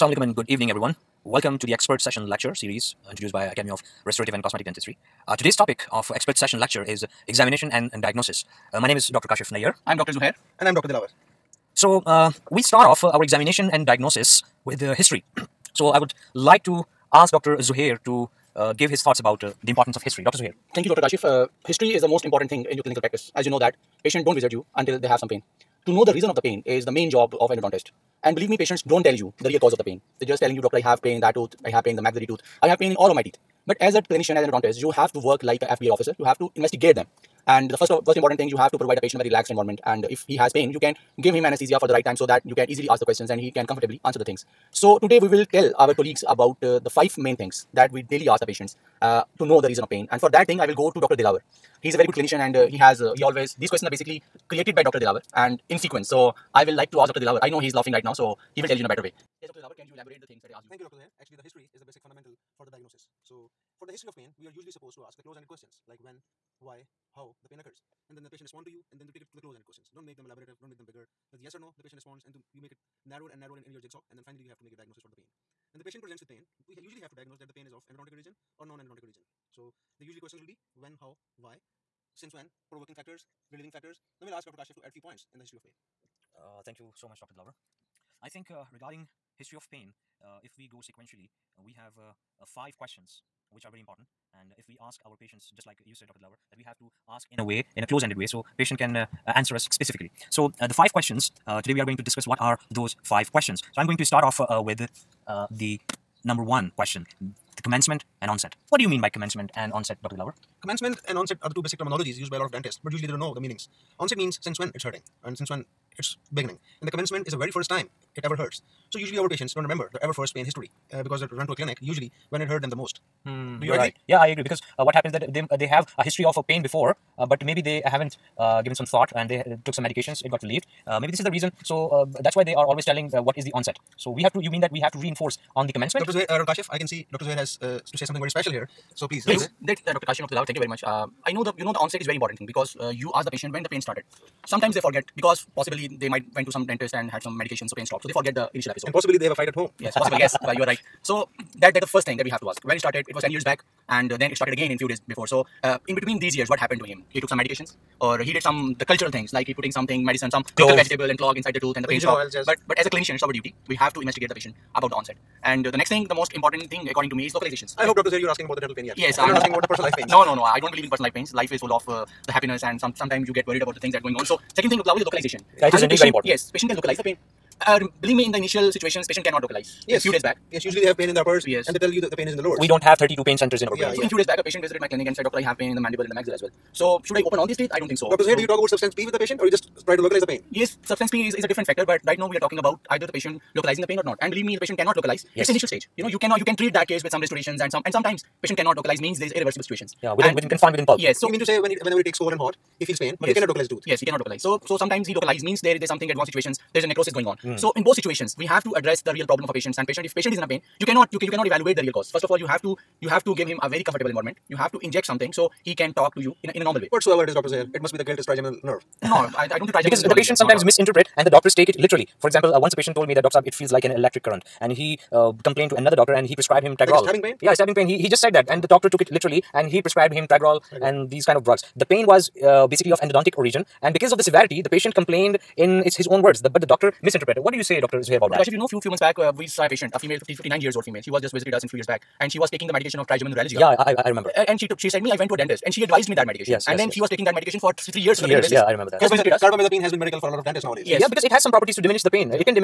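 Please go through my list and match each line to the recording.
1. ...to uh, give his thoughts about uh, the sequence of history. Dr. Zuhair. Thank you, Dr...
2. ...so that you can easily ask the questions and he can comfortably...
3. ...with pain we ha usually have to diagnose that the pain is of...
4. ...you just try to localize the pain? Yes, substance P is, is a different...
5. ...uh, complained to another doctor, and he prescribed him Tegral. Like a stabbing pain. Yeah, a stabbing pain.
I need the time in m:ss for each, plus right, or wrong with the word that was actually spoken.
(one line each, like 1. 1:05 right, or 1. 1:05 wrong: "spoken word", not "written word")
1. 0:18 wrong: "importance", not "sequence"
2. 0:42 right
3. 1:16 right
4. 3:09 right
5. 3:45 right.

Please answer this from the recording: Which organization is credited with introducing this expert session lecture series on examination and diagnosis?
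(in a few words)
Academy of Restorative and Cosmetic Dentistry.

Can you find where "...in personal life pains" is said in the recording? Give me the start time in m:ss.
2:50.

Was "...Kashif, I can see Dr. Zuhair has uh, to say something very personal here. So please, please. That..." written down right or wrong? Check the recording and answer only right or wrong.
wrong.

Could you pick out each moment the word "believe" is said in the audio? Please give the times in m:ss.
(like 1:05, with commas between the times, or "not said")
0:28, 2:50, 2:58, 3:14.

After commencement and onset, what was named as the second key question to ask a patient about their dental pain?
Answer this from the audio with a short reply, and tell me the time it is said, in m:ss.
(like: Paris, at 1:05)
Localization, at 2:55.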